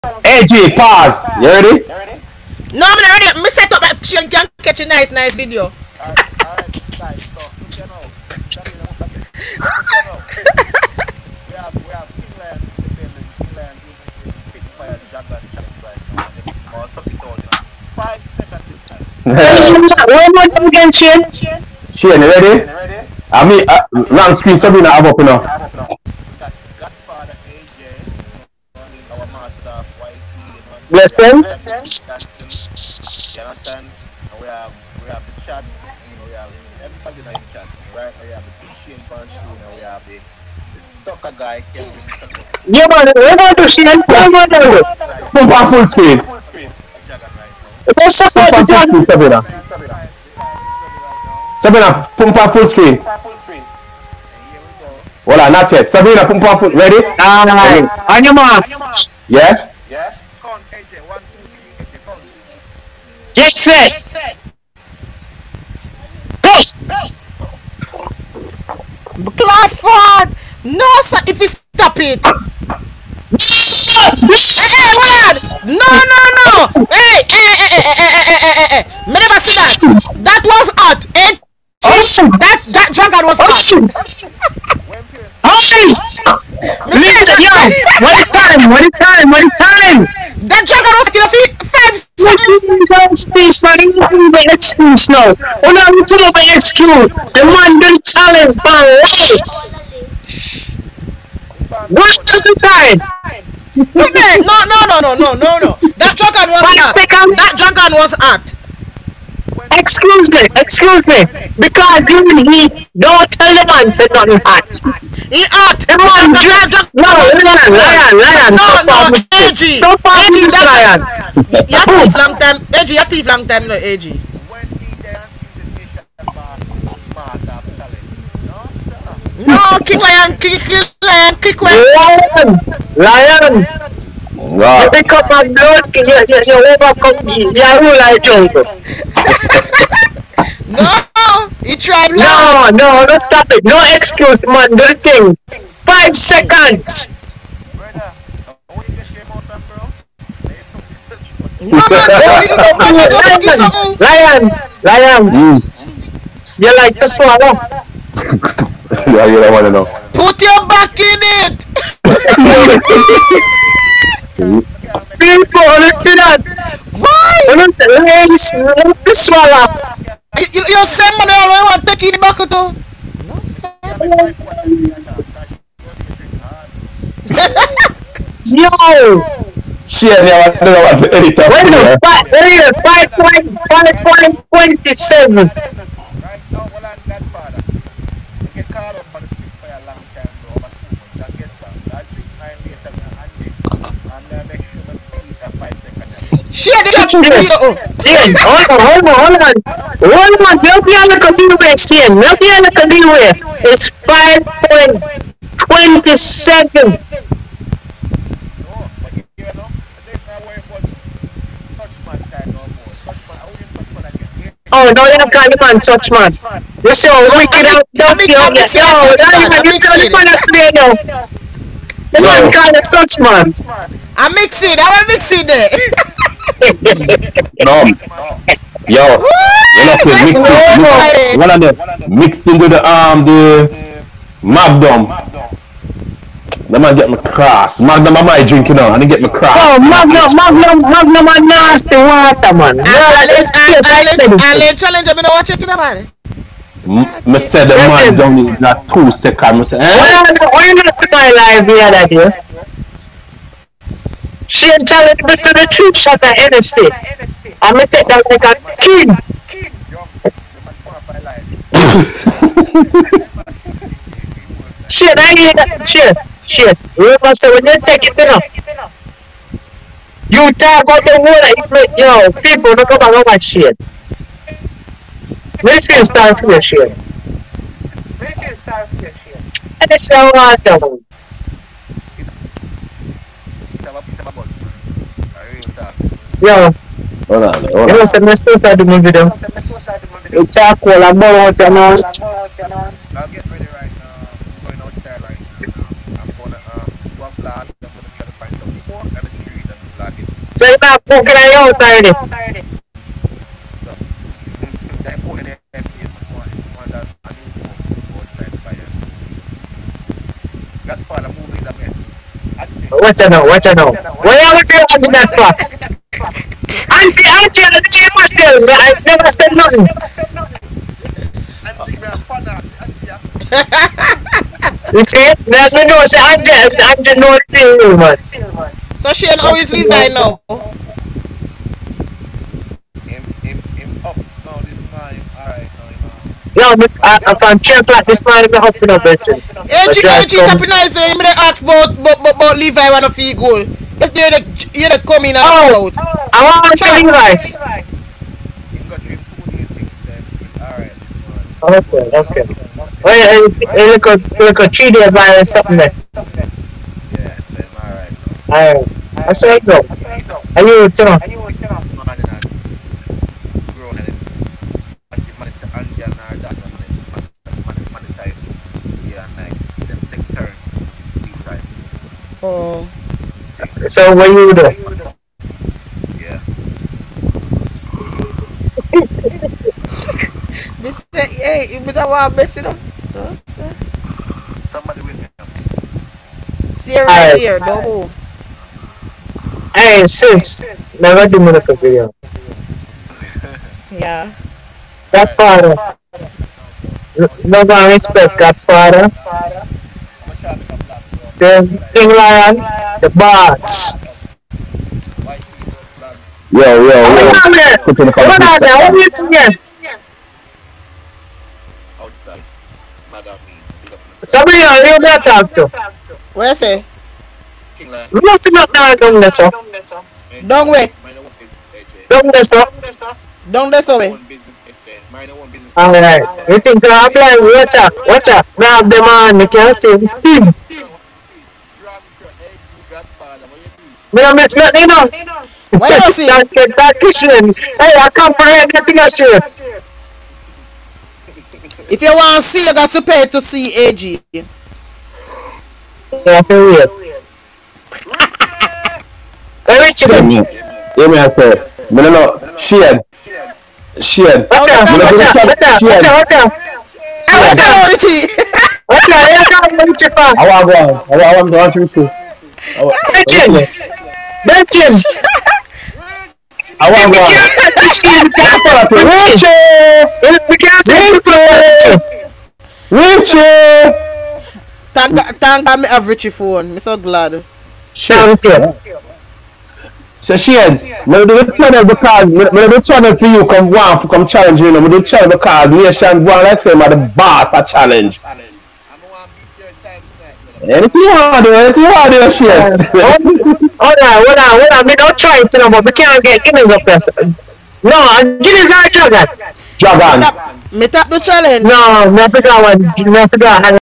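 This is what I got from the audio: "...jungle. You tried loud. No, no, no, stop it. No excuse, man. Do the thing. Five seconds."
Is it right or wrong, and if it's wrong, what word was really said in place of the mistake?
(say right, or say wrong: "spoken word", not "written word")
right.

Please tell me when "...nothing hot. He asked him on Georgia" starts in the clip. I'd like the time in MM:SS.
01:54.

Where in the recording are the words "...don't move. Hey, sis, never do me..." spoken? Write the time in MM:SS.
06:27.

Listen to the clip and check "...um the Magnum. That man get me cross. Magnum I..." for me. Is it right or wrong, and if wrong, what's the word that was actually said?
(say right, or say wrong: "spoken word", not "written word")
right.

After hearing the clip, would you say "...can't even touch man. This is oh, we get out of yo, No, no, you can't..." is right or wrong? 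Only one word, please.
right.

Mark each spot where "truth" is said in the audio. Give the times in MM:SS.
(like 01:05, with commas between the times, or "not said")
04:15.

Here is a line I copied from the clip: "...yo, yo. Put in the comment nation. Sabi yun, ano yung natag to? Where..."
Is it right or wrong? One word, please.
wrong.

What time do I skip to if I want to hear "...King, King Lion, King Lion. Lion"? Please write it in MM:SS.
02:10.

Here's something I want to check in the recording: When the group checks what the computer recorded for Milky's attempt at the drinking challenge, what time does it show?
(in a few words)
5.20 seconds.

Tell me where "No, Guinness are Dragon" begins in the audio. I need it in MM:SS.
08:17.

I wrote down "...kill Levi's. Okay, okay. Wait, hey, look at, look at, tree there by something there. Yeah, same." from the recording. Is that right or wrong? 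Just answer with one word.
right.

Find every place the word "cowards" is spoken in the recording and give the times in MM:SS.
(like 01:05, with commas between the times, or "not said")
not said.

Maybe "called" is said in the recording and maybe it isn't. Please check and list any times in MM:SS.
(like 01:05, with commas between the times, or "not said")
00:17.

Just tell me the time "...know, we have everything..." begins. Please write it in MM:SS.
00:36.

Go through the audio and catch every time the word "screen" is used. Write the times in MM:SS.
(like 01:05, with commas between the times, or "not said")
00:24, 00:45, 00:52.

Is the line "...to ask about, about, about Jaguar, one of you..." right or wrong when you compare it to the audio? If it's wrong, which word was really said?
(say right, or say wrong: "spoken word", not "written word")
wrong: "Levi", not "Jaguar".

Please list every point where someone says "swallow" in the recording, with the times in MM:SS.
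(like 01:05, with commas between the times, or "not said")
02:37, 02:49.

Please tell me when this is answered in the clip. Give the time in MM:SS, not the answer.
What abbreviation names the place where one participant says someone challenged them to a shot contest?
04:16.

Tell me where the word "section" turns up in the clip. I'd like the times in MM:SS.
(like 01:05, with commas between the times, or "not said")
06:48.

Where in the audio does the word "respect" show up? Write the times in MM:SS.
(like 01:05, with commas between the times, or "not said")
06:37.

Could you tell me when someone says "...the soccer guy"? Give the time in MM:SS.
00:40.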